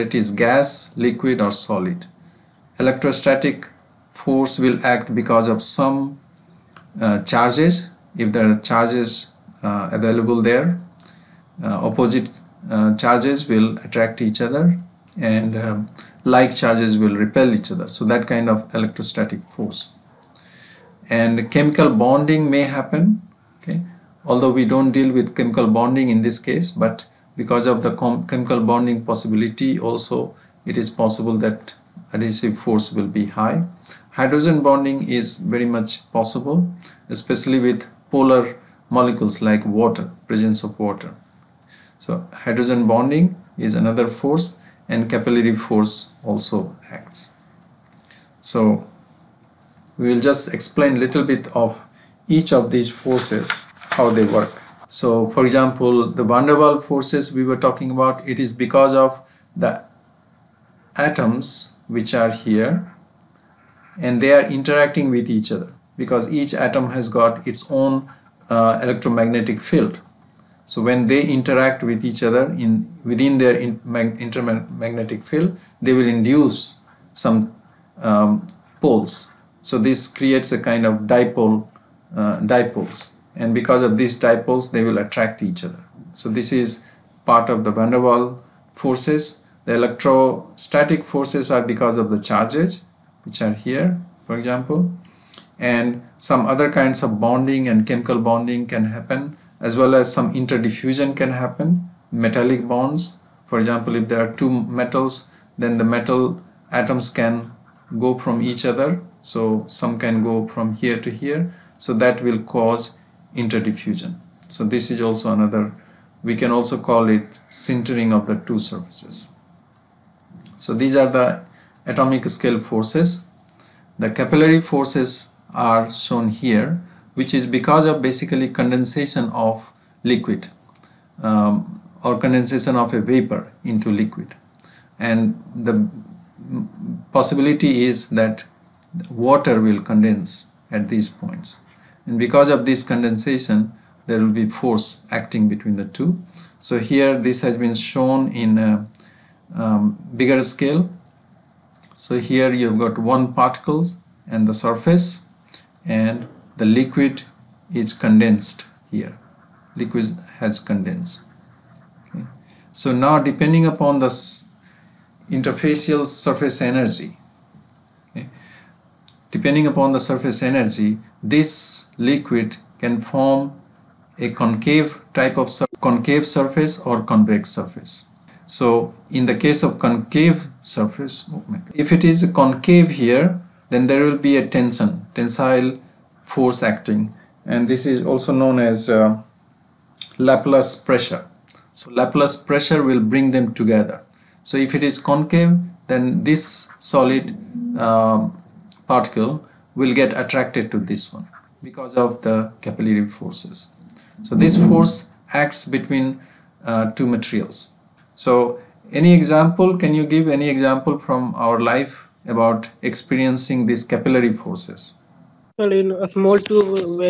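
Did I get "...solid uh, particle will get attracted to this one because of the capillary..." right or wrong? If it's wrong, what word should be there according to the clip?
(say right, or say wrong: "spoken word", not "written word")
right.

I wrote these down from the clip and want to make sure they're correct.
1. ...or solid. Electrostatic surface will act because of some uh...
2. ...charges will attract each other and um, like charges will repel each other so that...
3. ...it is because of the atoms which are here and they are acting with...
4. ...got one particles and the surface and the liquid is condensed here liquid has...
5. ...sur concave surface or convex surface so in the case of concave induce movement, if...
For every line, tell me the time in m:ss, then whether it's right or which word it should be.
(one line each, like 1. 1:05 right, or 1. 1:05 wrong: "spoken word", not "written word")
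1. 0:01 wrong: "force", not "surface"
2. 0:13 right
3. 0:58 wrong: "interacting", not "acting"
4. 2:32 right
5. 2:55 wrong: "surface", not "induce".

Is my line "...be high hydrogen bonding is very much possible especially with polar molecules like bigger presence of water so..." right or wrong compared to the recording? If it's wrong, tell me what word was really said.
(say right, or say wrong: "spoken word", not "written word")
wrong: "water", not "bigger".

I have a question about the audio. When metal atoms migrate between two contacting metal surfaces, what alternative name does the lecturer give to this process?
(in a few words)
Sintering.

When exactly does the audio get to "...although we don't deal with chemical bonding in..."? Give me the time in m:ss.
0:24.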